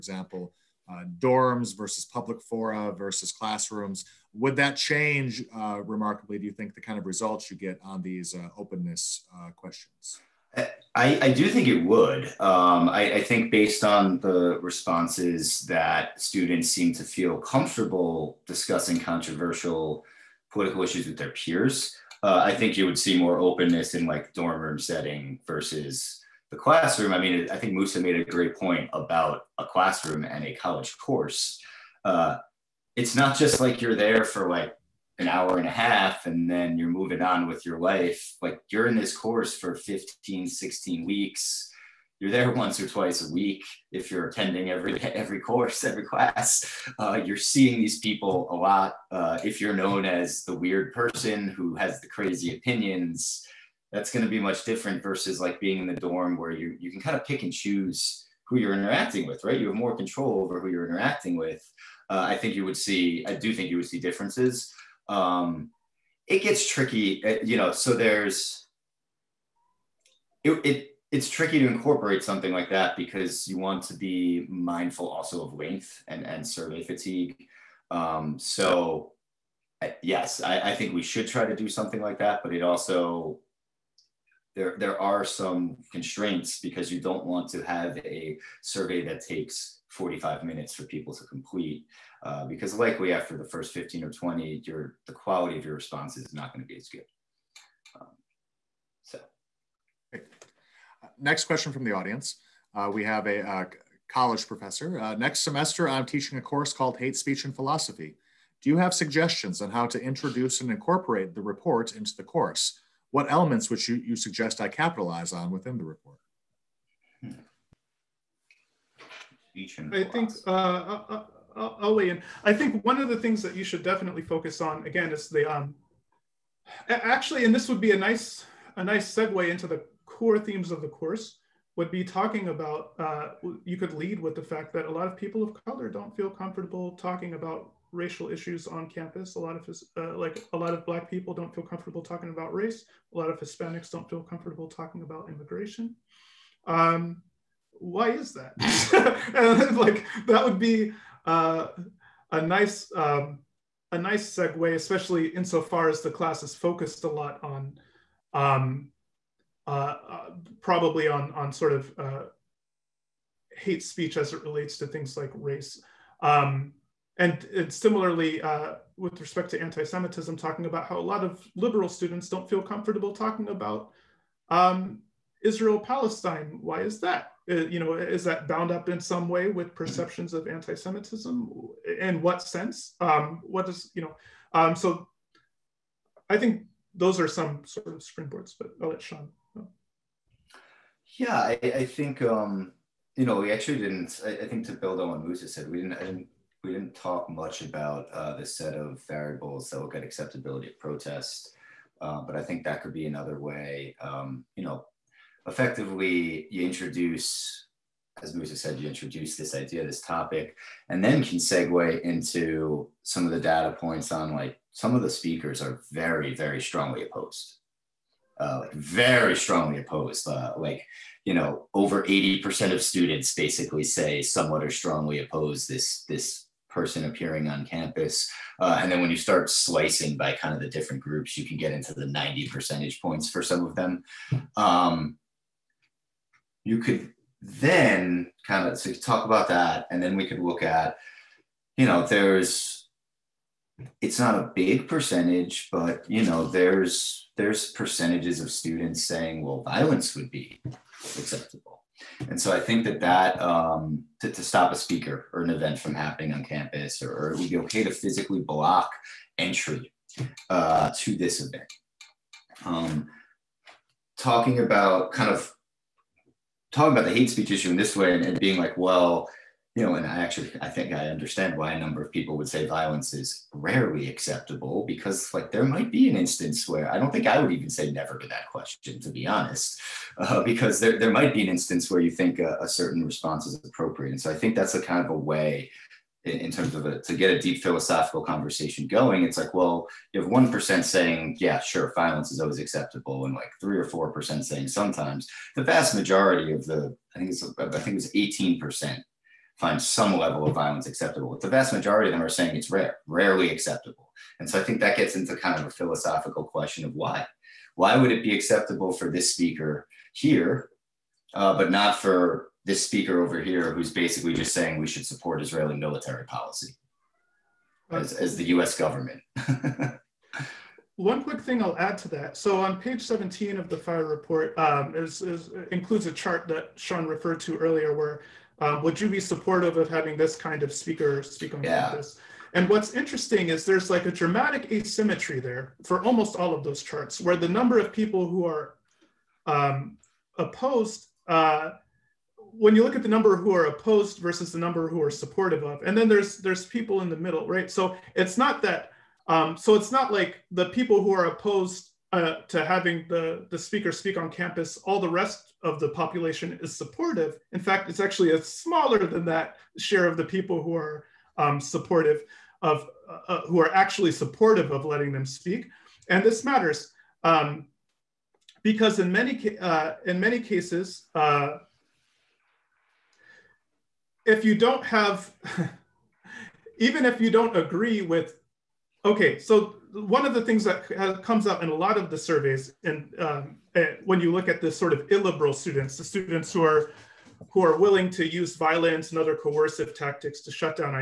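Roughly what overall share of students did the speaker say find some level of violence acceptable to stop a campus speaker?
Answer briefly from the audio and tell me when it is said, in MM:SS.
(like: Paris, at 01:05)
18%, at 04:58.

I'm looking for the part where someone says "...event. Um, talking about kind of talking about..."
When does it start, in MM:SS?
04:21.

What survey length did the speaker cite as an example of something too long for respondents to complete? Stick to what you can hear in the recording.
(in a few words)
45 minutes.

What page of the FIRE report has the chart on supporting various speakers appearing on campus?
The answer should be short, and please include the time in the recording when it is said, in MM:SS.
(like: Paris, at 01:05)
17, at 05:22.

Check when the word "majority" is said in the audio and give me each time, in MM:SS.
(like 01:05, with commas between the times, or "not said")
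04:55, 05:01.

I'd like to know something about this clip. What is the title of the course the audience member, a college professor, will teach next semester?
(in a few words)
Hate Speech and Philosophy.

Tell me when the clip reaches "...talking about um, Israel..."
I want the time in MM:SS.
02:53.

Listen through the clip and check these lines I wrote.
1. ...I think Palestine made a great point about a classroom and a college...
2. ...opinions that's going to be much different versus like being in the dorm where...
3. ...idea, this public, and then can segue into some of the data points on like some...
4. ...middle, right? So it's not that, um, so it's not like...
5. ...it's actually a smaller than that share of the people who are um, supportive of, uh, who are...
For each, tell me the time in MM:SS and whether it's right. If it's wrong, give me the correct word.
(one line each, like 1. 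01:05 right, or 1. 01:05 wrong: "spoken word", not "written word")
1. 00:27 wrong: "Musa", not "Palestine"
2. 00:52 right
3. 03:29 wrong: "topic", not "public"
4. 05:47 right
5. 05:57 right.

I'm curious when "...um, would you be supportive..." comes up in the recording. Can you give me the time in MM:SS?
05:28.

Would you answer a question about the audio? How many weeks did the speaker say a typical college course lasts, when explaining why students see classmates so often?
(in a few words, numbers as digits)
15, 16 weeks.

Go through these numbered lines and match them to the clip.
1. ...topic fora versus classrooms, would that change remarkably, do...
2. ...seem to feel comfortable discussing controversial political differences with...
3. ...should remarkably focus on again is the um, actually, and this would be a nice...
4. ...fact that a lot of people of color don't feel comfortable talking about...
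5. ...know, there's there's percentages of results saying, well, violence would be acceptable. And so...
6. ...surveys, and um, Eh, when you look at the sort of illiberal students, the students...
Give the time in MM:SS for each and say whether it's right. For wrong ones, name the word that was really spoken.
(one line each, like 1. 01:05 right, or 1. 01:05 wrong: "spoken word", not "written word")
1. 00:02 wrong: "public", not "topic"
2. 00:16 wrong: "issues", not "differences"
3. 02:03 wrong: "definitely", not "remarkably"
4. 02:14 right
5. 04:06 wrong: "students", not "results"
6. 06:22 right.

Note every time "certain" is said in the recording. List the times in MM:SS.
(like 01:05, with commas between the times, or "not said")
04:42.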